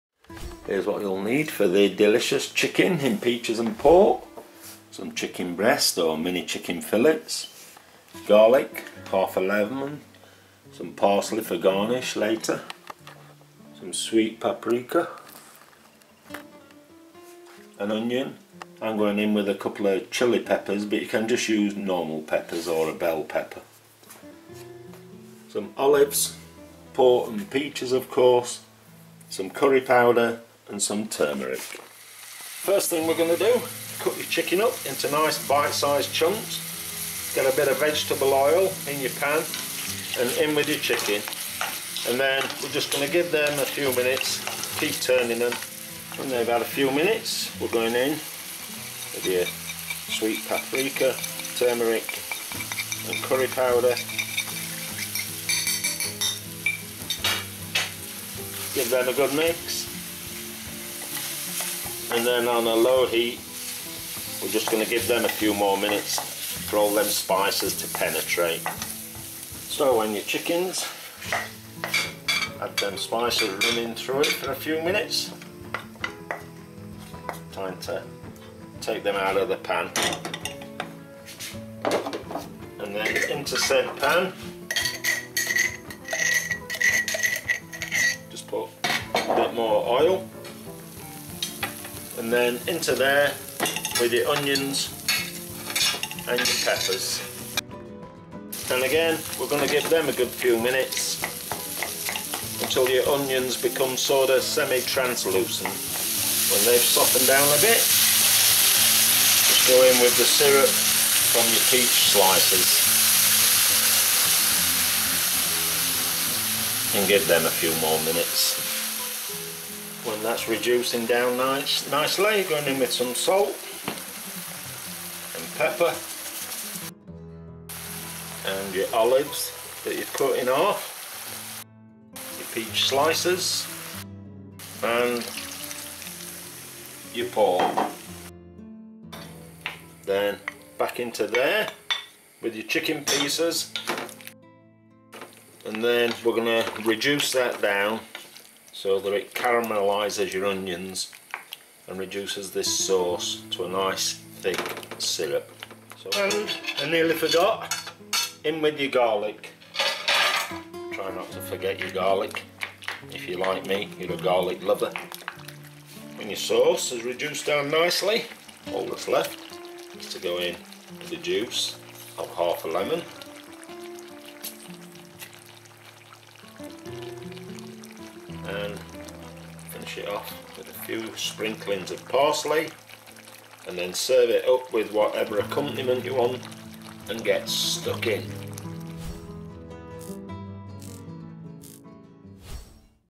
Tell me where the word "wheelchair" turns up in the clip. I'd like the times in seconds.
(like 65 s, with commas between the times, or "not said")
not said.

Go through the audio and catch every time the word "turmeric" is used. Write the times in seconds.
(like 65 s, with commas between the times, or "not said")
31 s, 51 s.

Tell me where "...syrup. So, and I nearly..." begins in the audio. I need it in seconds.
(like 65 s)
154 s.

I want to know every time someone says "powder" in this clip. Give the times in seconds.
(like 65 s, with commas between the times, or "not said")
29 s, 53 s.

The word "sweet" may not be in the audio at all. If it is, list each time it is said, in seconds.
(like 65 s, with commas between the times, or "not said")
13 s, 50 s.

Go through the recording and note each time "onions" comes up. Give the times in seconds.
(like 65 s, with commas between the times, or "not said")
17 s, 94 s, 103 s, 150 s.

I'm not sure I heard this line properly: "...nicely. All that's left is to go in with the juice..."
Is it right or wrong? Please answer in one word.
right.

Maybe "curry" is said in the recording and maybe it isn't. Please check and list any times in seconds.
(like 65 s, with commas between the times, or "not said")
29 s, 53 s.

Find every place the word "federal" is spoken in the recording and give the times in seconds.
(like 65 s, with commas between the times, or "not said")
not said.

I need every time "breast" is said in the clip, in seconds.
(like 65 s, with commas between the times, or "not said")
5 s.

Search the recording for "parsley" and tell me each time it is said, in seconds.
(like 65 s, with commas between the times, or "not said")
10 s, 182 s.